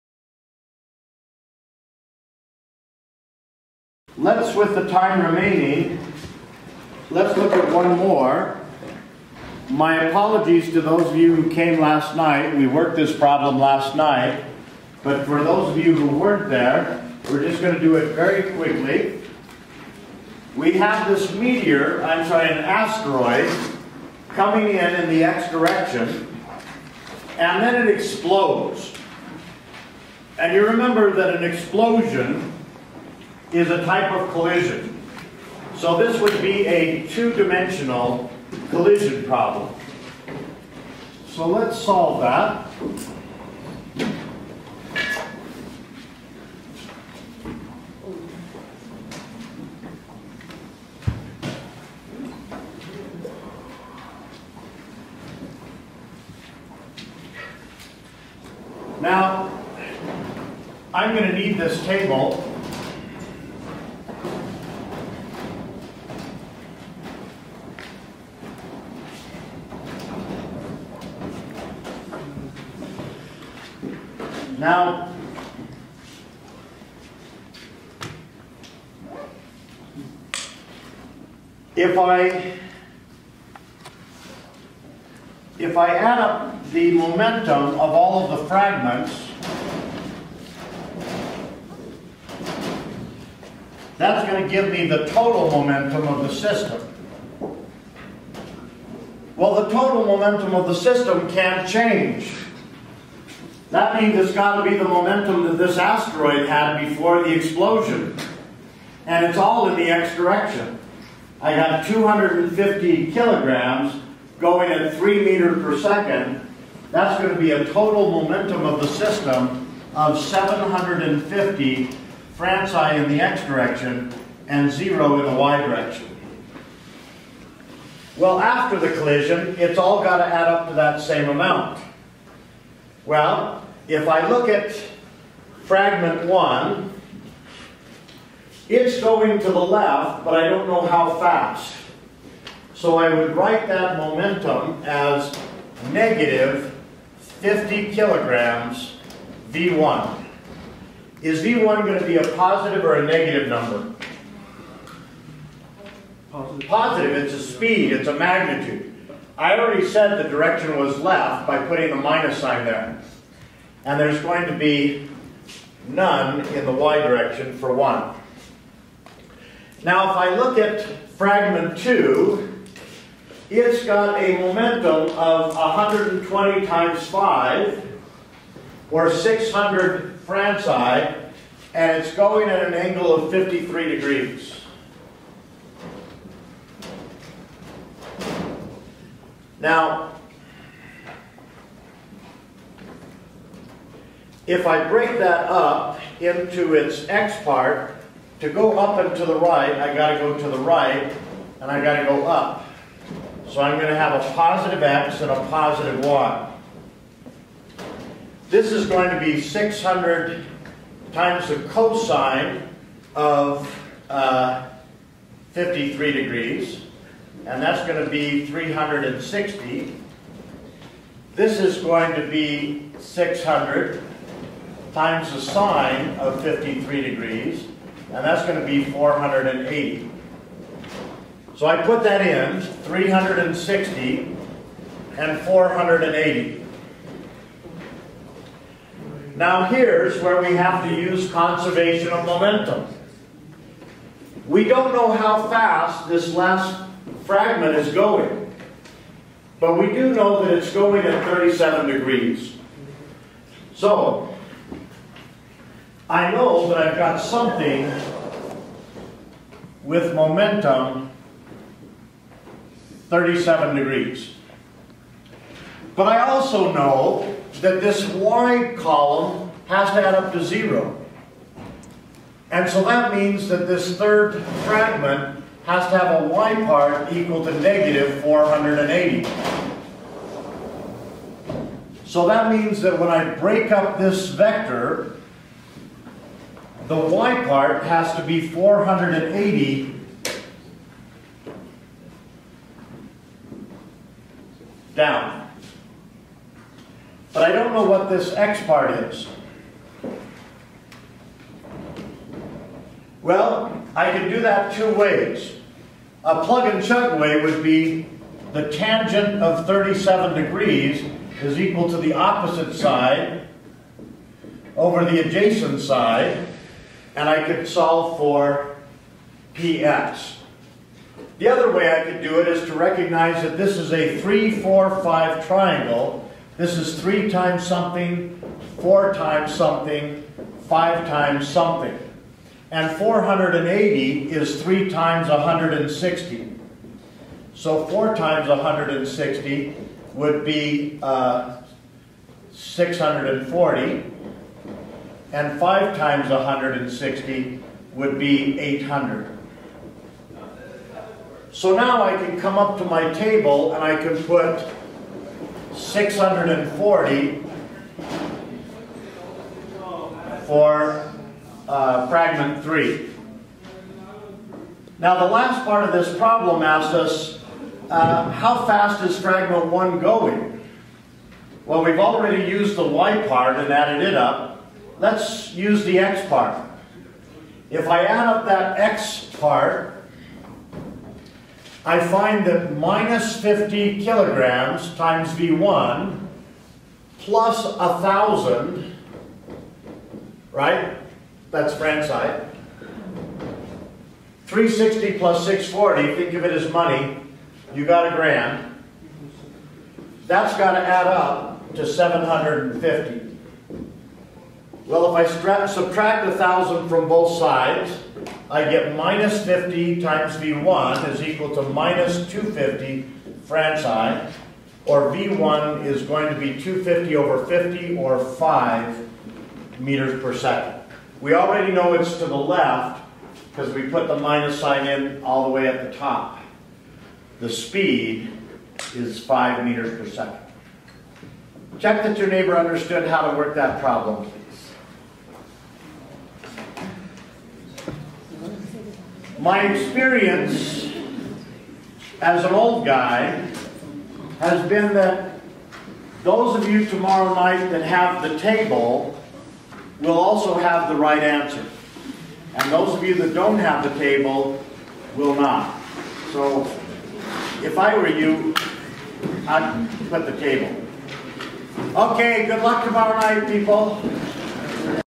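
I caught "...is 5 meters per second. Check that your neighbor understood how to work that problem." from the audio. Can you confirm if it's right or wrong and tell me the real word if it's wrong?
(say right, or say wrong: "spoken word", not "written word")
right.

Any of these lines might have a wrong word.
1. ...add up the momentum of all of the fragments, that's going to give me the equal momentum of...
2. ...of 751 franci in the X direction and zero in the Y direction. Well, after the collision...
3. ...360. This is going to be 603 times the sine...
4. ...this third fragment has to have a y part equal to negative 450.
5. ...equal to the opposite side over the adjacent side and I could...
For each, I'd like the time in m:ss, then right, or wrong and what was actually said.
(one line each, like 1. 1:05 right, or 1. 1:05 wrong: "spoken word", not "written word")
1. 1:25 wrong: "total", not "equal"
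2. 1:59 wrong: "750", not "751"
3. 3:38 wrong: "600", not "603"
4. 4:33 wrong: "480", not "450"
5. 5:11 right.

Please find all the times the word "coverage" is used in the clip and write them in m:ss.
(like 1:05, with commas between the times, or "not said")
not said.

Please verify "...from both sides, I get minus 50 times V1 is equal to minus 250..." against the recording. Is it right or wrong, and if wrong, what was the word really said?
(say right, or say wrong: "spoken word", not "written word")
right.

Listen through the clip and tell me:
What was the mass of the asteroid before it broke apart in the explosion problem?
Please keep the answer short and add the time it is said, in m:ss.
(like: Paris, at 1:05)
250 kilograms, at 1:51.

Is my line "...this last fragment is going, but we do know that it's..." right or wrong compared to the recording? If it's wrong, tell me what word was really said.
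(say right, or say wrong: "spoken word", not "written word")
right.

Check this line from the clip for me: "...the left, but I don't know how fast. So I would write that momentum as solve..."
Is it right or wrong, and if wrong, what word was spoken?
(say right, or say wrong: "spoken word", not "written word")
wrong: "negative", not "solve".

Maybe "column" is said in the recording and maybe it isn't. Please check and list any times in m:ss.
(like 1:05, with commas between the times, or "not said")
4:28.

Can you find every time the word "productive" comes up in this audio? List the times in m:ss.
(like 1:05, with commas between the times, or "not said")
not said.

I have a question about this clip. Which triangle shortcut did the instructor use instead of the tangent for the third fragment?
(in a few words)
3, 4, 5 triangle.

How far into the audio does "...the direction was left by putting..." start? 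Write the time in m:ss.
2:40.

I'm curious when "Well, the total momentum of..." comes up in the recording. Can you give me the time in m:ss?
1:39.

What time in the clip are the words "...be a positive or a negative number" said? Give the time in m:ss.
2:32.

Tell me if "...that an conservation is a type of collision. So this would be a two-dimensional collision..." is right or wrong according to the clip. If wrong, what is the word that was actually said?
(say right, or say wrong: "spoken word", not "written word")
wrong: "explosion", not "conservation".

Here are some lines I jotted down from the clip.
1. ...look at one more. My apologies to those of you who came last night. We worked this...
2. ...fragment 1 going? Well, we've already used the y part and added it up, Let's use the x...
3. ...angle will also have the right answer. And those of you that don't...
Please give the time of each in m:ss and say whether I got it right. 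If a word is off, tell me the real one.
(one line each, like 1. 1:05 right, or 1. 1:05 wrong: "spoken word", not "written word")
1. 0:07 right
2. 6:09 right
3. 7:28 wrong: "table", not "angle".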